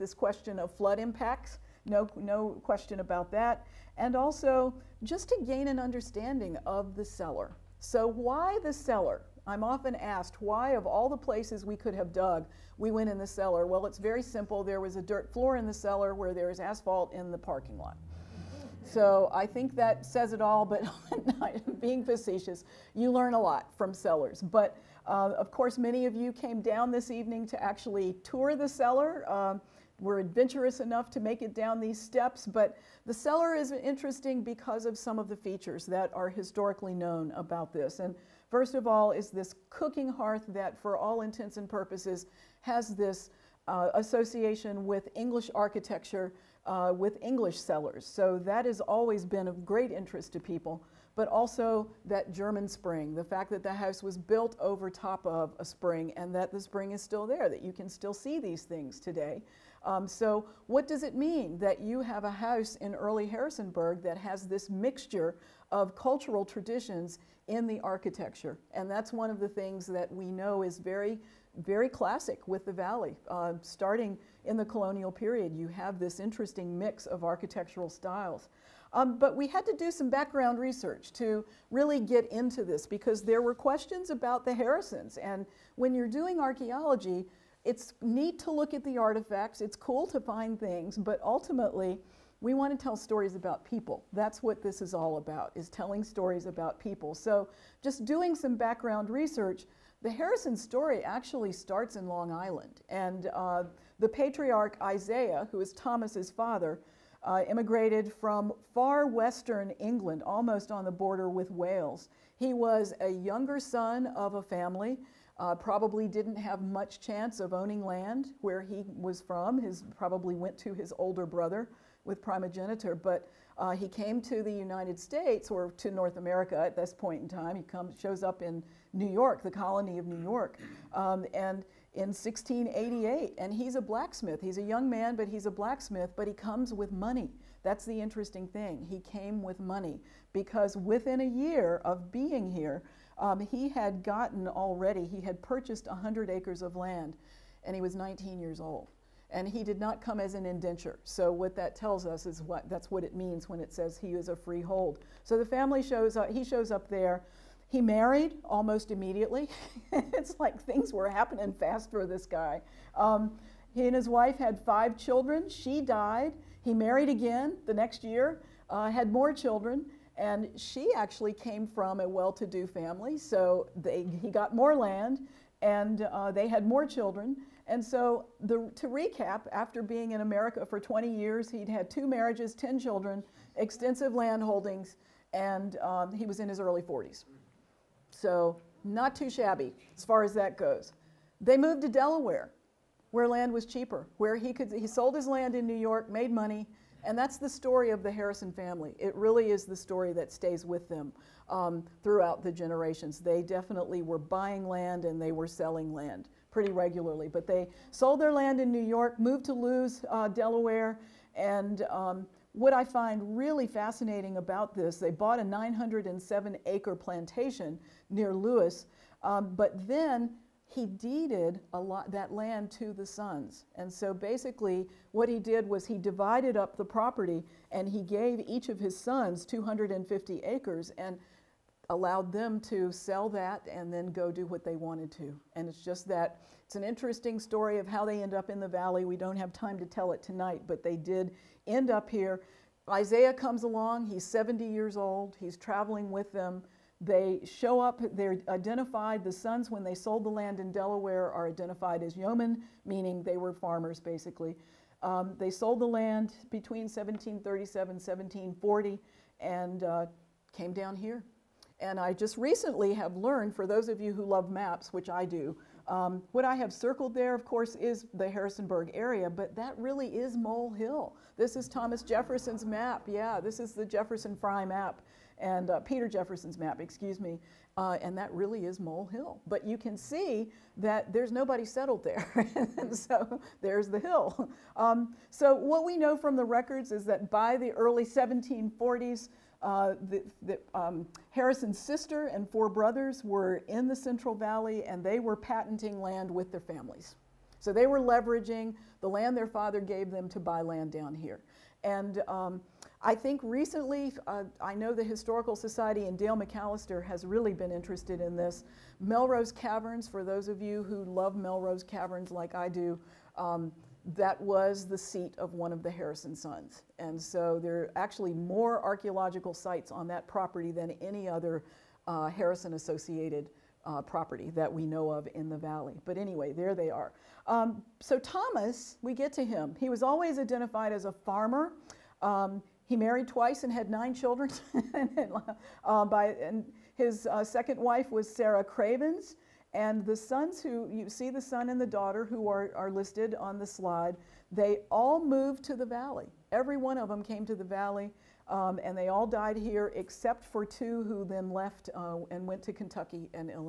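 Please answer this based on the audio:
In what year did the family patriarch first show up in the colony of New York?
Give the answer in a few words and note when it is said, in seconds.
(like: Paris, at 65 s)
1688, at 132 s.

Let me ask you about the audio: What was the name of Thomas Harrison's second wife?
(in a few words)
Sarah Cravens.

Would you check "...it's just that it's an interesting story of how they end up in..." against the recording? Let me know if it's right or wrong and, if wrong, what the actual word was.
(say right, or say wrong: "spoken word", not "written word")
right.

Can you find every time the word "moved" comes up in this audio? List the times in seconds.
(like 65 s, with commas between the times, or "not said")
191 s, 209 s, 345 s.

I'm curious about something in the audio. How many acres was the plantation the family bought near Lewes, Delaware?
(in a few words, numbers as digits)
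907.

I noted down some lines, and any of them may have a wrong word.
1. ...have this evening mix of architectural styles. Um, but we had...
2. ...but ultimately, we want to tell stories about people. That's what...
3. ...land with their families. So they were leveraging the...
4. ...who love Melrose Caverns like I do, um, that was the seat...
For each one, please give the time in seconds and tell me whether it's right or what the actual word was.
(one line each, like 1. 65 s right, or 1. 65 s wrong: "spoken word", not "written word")
1. 75 s wrong: "interesting", not "evening"
2. 90 s right
3. 296 s right
4. 310 s right.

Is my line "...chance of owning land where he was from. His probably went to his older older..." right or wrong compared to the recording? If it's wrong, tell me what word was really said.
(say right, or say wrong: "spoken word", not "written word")
wrong: "brother", not "older".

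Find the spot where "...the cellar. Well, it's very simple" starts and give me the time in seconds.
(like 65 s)
13 s.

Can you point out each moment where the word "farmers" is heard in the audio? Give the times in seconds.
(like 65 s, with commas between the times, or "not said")
253 s, 331 s.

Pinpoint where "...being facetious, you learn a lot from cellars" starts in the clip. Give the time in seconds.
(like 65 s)
21 s.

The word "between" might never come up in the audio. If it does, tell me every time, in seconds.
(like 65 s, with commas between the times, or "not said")
256 s.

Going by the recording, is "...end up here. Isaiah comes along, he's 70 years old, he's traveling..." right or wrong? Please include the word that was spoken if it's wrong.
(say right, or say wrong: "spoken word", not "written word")
right.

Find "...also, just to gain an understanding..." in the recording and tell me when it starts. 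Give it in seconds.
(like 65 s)
4 s.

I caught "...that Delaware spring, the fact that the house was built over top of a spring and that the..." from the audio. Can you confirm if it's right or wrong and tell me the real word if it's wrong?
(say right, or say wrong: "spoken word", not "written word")
wrong: "German", not "Delaware".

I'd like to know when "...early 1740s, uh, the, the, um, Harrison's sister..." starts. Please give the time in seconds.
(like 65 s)
287 s.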